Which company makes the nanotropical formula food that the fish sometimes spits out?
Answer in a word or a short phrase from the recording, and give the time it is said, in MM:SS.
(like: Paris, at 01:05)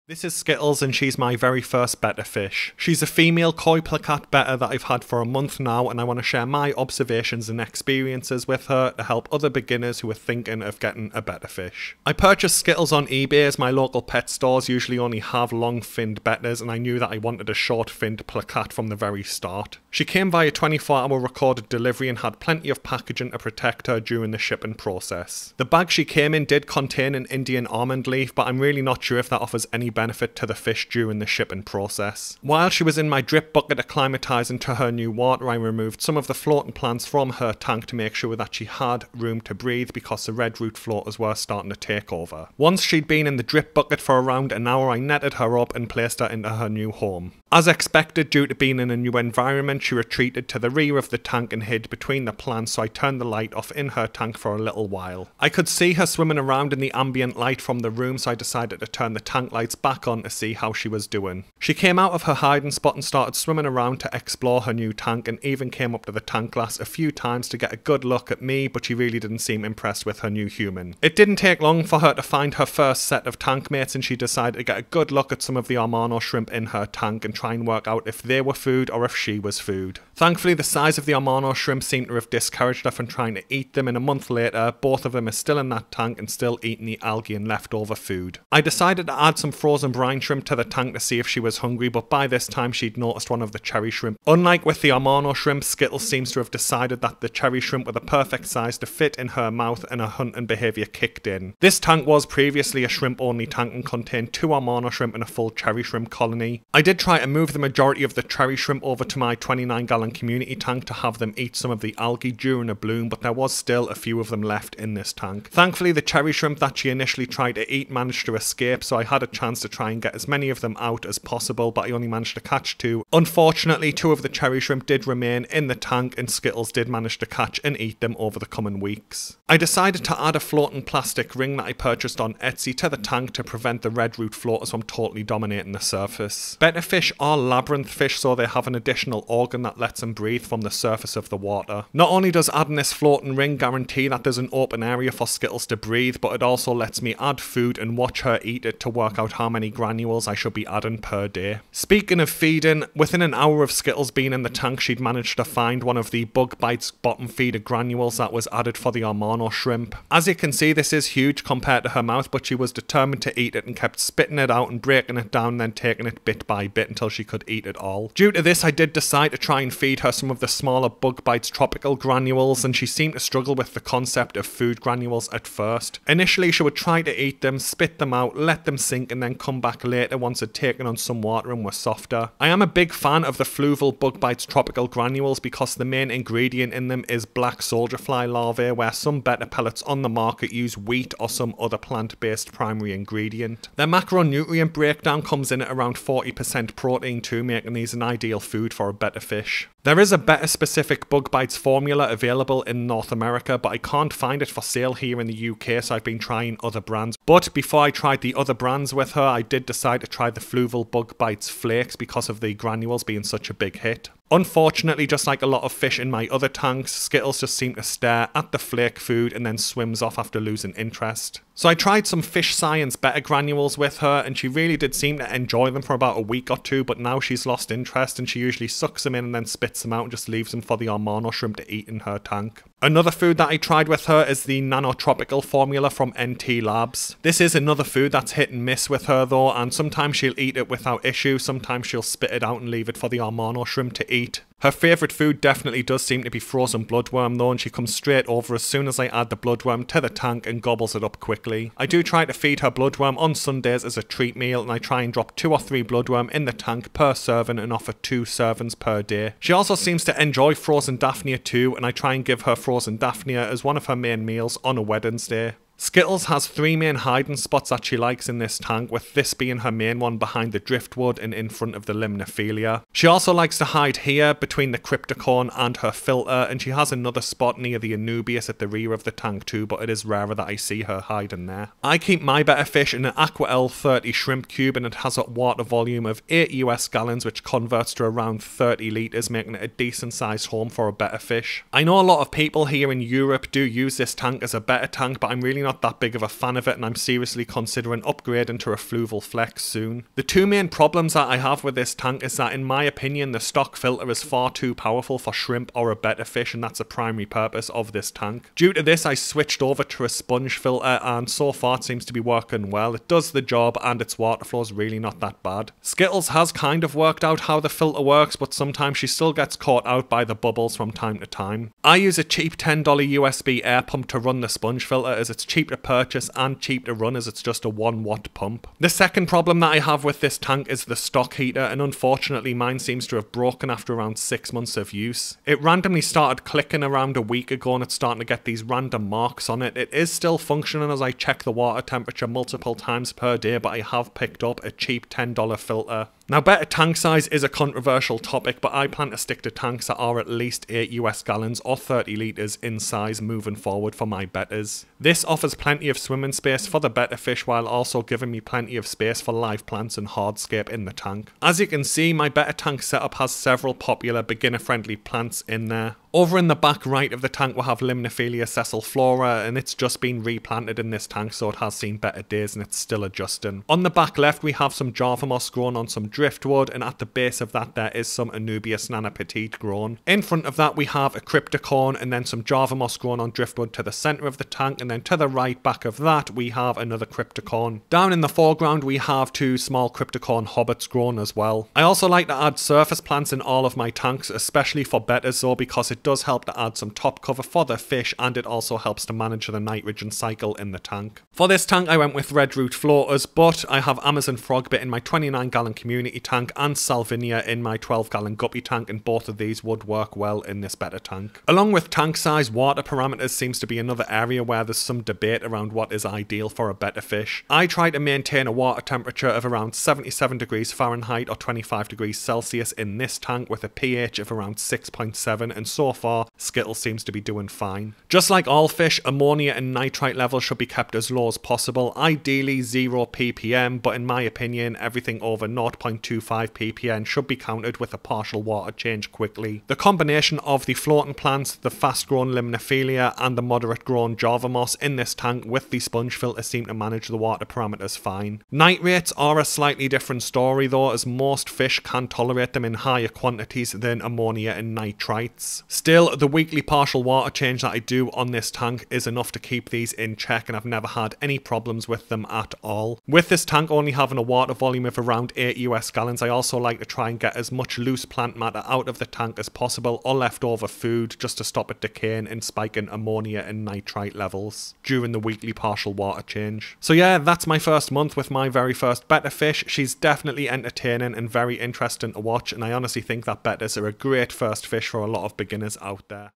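NT Labs, at 03:56.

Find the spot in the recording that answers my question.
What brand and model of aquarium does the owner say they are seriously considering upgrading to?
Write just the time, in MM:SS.
04:58.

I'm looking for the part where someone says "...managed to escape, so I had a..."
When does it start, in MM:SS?
01:57.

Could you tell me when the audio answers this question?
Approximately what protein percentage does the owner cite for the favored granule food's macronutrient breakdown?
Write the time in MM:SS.
03:15.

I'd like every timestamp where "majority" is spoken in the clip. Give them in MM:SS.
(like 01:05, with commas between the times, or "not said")
01:47.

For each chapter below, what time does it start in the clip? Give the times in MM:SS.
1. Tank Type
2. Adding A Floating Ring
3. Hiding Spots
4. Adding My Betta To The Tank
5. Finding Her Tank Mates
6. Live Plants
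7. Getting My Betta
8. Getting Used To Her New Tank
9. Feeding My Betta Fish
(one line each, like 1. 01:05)
1. 04:41
2. 02:13
3. 04:25
4. 00:32
5. 01:11
6. 06:01
7. 00:11
8. 00:47
9. 02:31.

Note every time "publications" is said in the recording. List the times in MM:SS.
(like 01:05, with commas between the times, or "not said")
not said.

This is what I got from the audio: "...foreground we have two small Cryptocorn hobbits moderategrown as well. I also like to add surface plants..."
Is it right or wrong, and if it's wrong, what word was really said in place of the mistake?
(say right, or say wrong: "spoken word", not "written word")
wrong: "grown", not "moderategrown".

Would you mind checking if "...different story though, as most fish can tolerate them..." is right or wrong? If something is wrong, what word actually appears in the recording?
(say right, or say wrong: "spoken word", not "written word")
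right.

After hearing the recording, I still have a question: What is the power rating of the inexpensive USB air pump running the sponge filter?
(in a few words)
1 watt.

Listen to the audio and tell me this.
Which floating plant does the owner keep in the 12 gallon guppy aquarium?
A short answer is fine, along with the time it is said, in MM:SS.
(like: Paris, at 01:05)
salvinia, at 06:46.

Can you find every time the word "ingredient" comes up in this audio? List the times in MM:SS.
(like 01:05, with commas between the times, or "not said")
03:06, 03:12.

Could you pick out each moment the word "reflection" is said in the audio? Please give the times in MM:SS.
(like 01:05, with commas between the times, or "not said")
not said.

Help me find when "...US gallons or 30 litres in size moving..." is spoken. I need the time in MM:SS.
05:50.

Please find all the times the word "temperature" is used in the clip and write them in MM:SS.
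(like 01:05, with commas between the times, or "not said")
05:41, 06:58.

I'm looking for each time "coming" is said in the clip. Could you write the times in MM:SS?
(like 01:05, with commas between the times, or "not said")
02:08.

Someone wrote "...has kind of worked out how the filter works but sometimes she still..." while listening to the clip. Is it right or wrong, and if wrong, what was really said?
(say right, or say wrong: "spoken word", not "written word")
right.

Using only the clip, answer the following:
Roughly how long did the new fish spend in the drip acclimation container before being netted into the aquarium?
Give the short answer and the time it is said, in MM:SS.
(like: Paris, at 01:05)
around an hour, at 00:44.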